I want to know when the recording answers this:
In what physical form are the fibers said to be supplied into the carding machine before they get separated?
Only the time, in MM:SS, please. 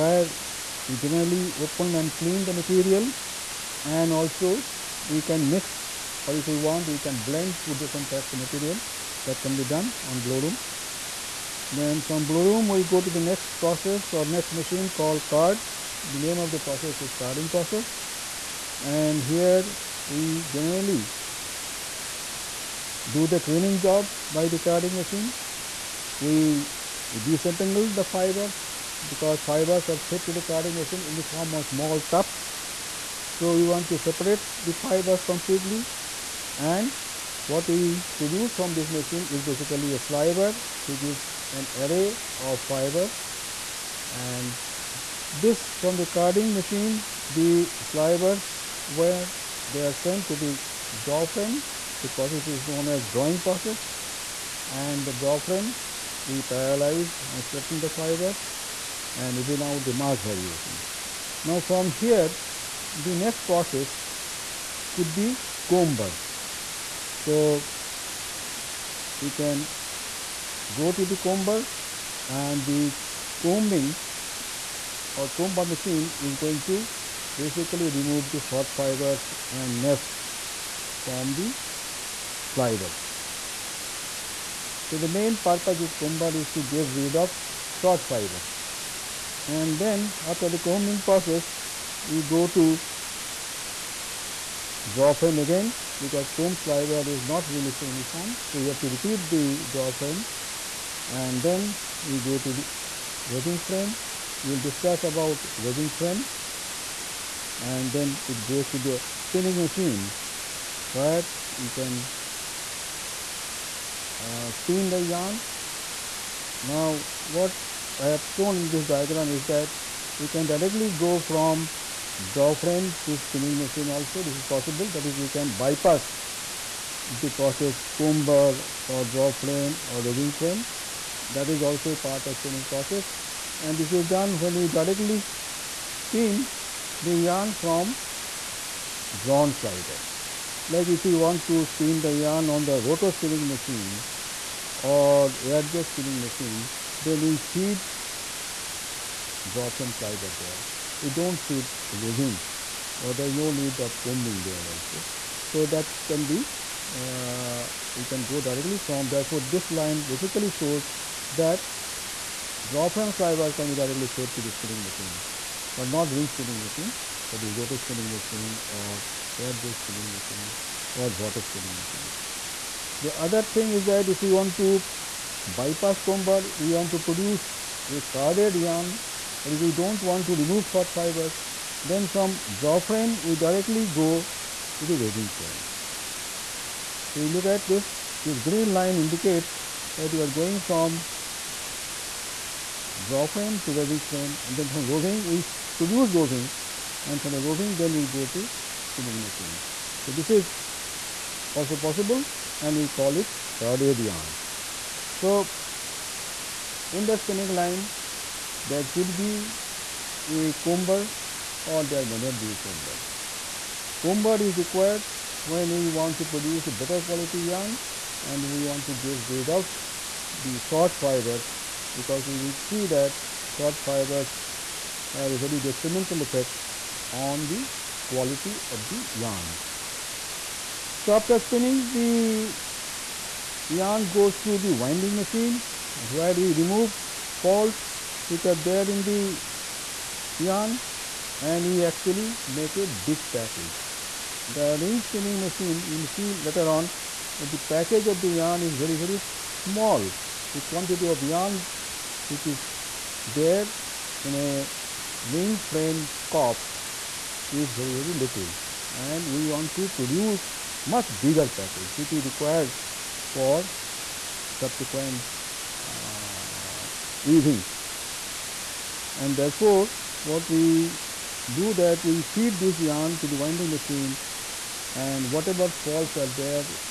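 00:31.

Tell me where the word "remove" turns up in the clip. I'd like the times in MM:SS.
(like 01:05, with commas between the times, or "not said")
01:17, 03:00, 03:56.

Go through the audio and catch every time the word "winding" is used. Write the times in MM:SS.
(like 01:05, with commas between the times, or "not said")
03:54, 04:33.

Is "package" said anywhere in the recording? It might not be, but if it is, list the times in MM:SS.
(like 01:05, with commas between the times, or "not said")
04:03, 04:07, 04:21.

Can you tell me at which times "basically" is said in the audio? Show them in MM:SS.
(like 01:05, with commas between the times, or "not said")
00:39, 01:17, 02:40.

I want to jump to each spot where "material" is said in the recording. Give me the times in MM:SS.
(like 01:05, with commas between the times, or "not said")
00:02, 00:08.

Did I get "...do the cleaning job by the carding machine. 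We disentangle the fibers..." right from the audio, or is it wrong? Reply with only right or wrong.
right.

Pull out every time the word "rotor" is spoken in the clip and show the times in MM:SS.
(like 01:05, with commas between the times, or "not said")
02:22, 02:47.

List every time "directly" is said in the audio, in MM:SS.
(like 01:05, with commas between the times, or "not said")
02:00, 02:14, 02:38, 02:43, 03:03.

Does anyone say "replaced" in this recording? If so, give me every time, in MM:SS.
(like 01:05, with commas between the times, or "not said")
not said.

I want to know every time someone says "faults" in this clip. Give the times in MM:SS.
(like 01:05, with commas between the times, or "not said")
03:57, 04:35.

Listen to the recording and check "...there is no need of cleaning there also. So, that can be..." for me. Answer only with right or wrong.
wrong.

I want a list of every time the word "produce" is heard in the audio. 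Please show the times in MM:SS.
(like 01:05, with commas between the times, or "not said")
00:38, 02:56, 03:15, 03:36, 04:19.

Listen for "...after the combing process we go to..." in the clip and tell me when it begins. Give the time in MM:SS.
01:30.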